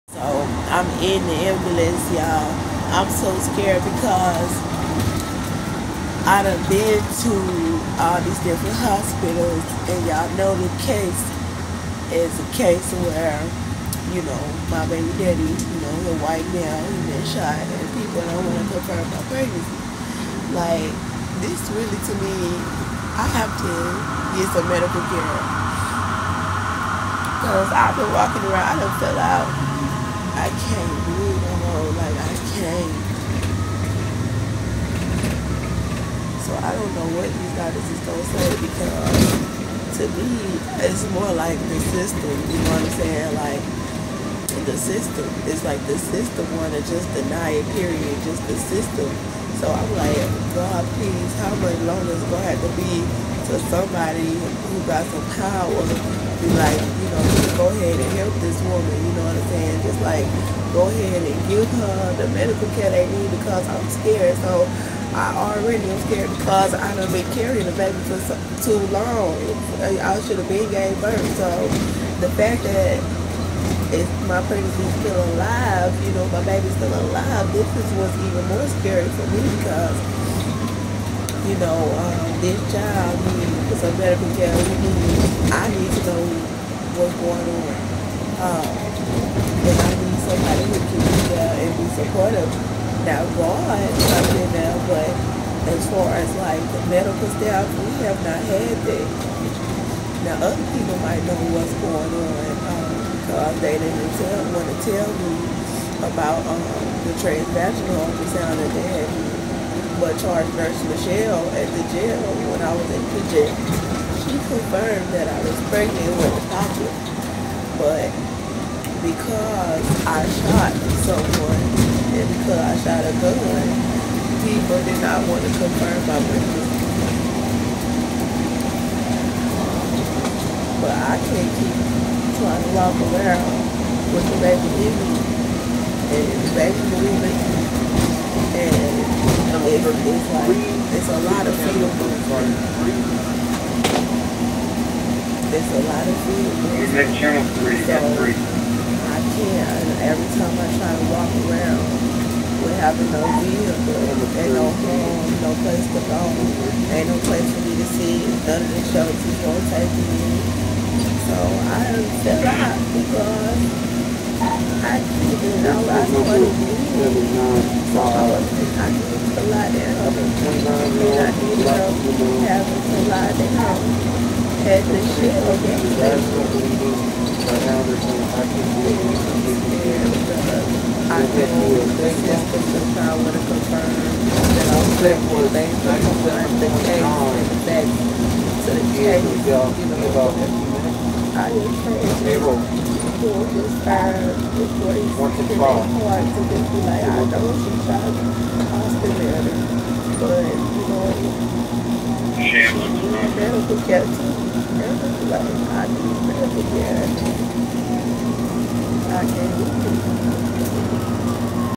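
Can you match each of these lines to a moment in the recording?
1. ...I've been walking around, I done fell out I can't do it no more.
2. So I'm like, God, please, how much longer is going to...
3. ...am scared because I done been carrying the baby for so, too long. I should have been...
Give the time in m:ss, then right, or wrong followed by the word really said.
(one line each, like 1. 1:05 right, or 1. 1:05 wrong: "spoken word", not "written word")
1. 0:27 right
2. 0:49 right
3. 1:05 right.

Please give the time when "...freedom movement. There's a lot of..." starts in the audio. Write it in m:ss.
2:21.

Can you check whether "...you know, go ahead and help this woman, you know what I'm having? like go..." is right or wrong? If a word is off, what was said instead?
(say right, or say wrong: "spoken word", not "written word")
wrong: "saying", not "having".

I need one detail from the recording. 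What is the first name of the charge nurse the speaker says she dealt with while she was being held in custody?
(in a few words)
Michelle.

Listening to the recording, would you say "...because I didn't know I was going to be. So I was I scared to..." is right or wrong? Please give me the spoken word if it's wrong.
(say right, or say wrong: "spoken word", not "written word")
wrong: "needed", not "scared".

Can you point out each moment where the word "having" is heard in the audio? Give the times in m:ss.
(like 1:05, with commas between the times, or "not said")
2:32, 2:52.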